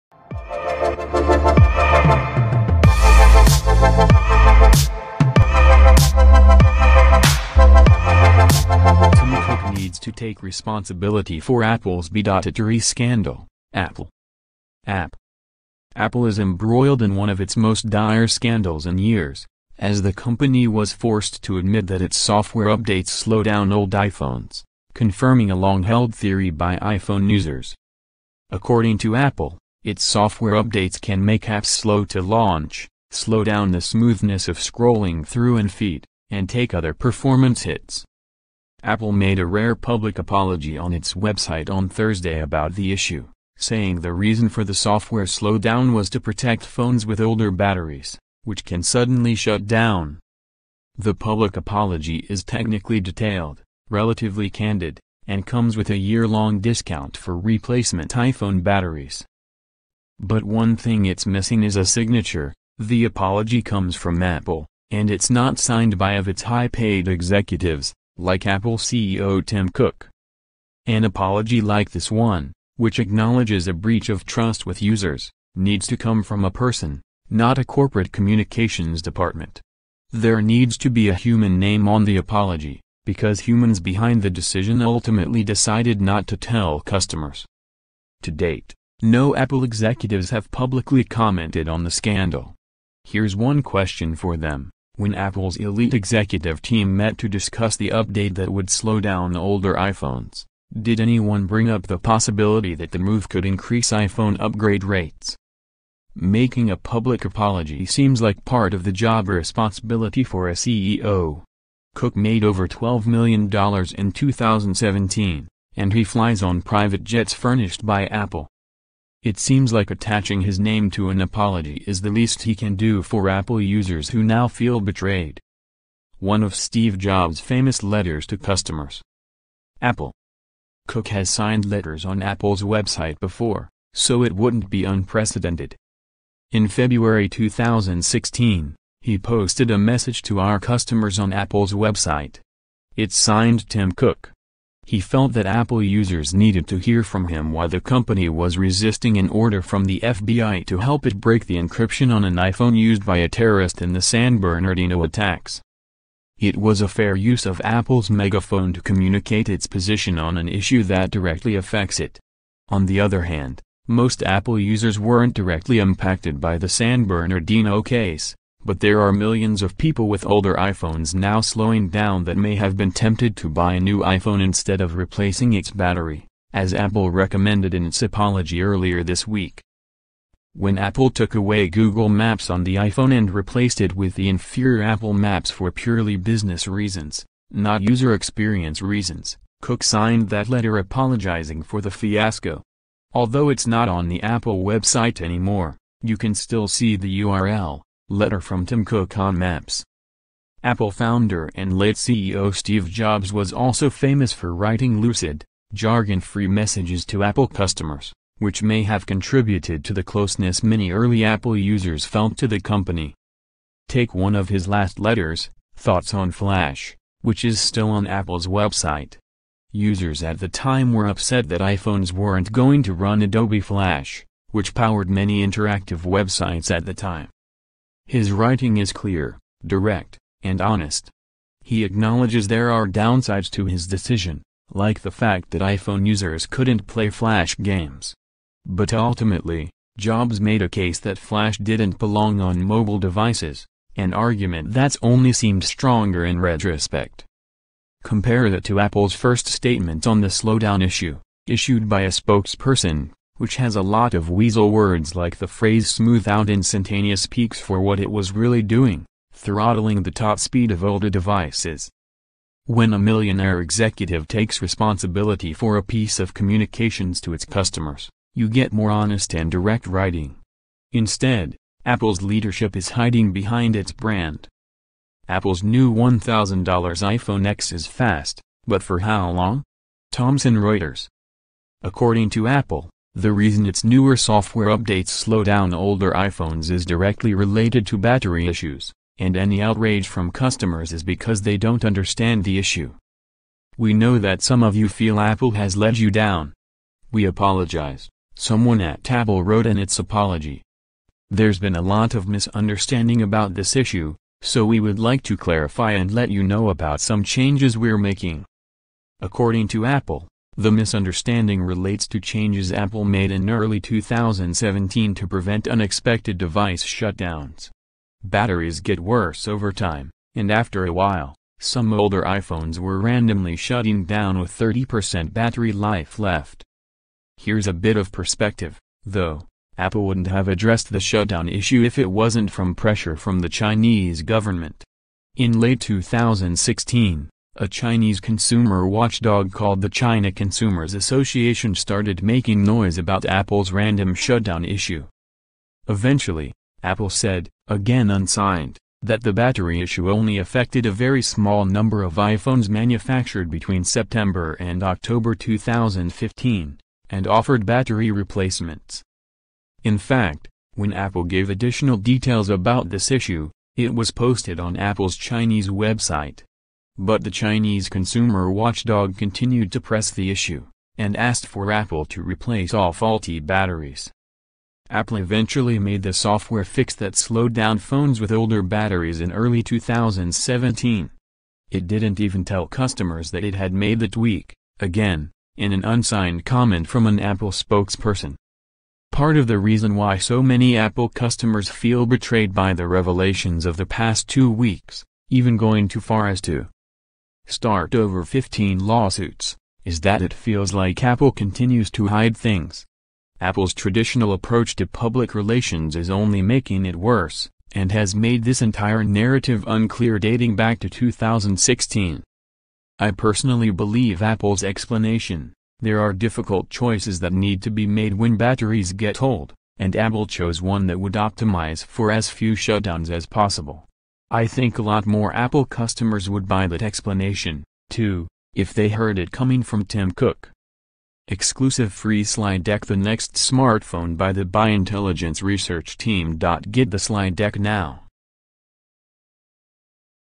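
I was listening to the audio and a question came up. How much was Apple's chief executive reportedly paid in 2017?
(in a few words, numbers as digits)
over $12 million.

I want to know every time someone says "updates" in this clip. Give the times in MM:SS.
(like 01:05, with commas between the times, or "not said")
00:22, 00:30, 01:37, 04:44.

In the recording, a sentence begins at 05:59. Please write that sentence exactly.
In fact, when Apple gave additional details about this issue, it was posted on Apple's Chinese website.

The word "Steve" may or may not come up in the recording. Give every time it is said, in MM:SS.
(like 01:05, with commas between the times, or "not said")
02:06, 03:22.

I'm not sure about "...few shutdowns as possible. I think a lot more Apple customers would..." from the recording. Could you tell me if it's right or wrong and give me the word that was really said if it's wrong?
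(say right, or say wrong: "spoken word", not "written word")
right.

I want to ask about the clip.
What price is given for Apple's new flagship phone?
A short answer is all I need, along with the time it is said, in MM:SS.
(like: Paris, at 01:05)
$1,000, at 04:35.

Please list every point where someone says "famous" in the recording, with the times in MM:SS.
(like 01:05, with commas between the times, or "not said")
02:07, 03:23.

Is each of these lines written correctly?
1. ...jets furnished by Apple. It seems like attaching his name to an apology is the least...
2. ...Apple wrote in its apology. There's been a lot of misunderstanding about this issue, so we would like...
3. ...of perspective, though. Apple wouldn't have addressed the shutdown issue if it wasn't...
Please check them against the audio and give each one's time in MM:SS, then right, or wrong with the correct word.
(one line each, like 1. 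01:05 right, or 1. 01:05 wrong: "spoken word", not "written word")
1. 01:57 right
2. 04:59 right
3. 05:27 right.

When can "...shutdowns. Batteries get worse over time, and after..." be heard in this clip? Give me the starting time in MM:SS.
05:16.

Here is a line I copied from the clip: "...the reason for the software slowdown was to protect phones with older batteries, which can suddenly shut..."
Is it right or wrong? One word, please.
right.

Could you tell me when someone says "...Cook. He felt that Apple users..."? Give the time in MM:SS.
02:23.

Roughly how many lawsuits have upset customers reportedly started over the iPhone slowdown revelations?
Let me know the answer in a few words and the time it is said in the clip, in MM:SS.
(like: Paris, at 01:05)
over 15, at 06:37.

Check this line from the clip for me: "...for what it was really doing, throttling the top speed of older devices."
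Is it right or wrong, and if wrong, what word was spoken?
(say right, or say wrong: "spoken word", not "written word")
right.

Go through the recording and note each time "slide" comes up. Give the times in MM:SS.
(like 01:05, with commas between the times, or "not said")
07:12, 07:16.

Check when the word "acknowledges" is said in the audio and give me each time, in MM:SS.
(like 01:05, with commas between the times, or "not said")
01:12, 03:51.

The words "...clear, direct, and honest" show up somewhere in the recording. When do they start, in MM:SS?
03:48.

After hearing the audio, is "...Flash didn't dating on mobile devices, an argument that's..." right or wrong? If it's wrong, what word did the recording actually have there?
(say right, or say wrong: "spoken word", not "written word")
wrong: "belong", not "dating".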